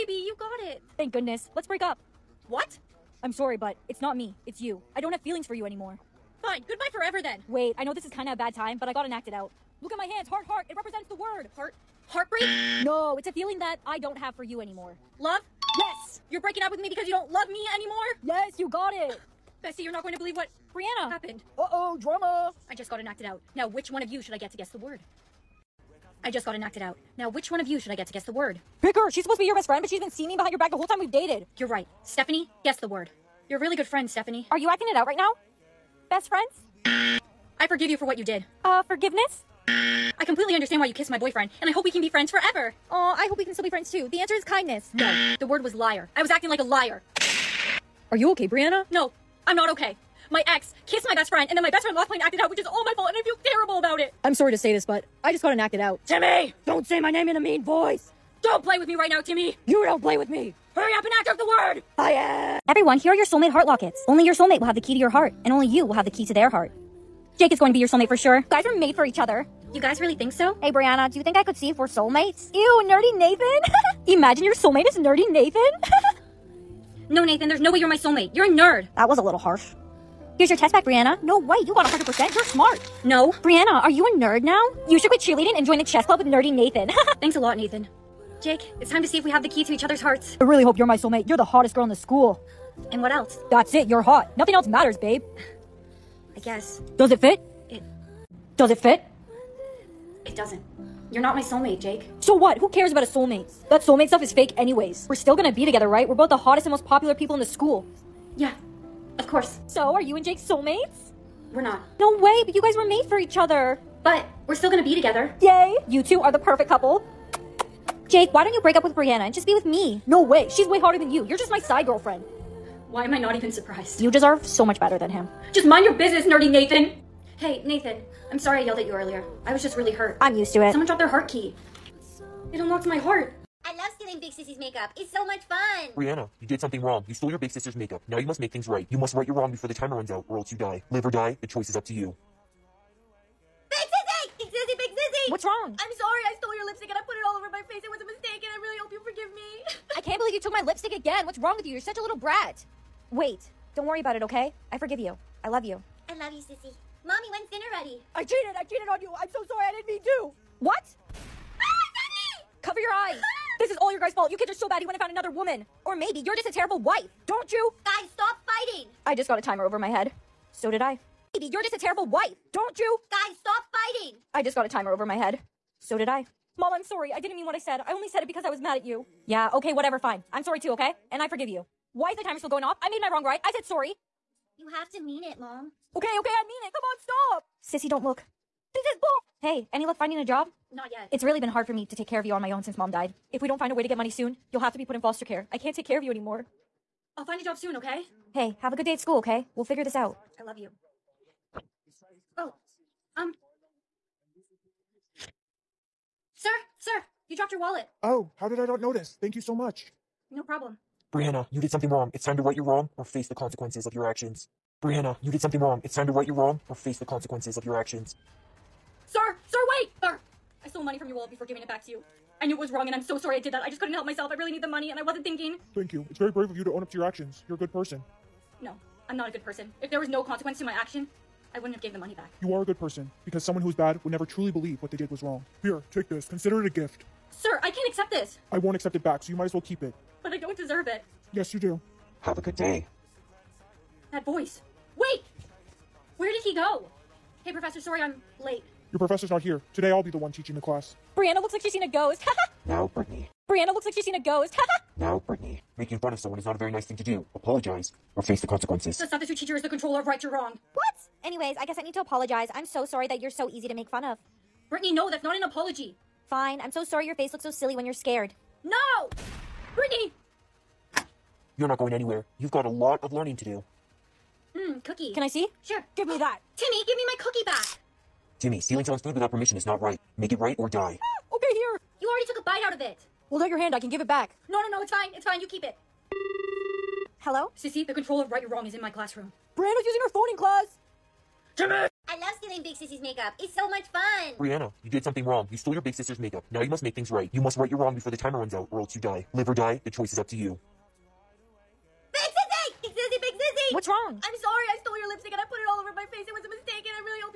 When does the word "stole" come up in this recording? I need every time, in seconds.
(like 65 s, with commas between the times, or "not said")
137 s, 146 s, 220 s, 295 s, 304 s.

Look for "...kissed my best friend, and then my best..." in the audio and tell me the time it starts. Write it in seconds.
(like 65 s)
50 s.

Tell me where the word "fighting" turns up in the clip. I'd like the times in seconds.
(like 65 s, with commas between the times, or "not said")
168 s, 173 s.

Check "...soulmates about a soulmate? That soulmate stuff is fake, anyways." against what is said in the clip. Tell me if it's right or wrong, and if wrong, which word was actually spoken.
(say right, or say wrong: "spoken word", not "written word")
wrong: "cares", not "soulmates".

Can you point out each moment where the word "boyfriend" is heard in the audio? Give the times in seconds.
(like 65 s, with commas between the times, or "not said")
41 s.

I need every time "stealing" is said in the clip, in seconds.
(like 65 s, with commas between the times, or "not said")
133 s, 278 s, 292 s.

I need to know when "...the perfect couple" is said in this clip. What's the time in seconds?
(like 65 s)
116 s.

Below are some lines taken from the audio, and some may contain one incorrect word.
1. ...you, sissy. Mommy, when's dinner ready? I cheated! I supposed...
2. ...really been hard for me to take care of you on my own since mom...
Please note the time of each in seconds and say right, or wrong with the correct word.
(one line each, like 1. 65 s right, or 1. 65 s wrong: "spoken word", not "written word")
1. 156 s wrong: "cheated", not "supposed"
2. 191 s right.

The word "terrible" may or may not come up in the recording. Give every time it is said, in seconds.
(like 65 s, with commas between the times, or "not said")
53 s, 166 s, 171 s.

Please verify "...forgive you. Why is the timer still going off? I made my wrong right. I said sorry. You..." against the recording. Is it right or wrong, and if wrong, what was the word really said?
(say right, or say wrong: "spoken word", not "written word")
right.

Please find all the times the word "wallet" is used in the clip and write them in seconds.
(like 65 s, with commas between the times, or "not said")
207 s, 221 s.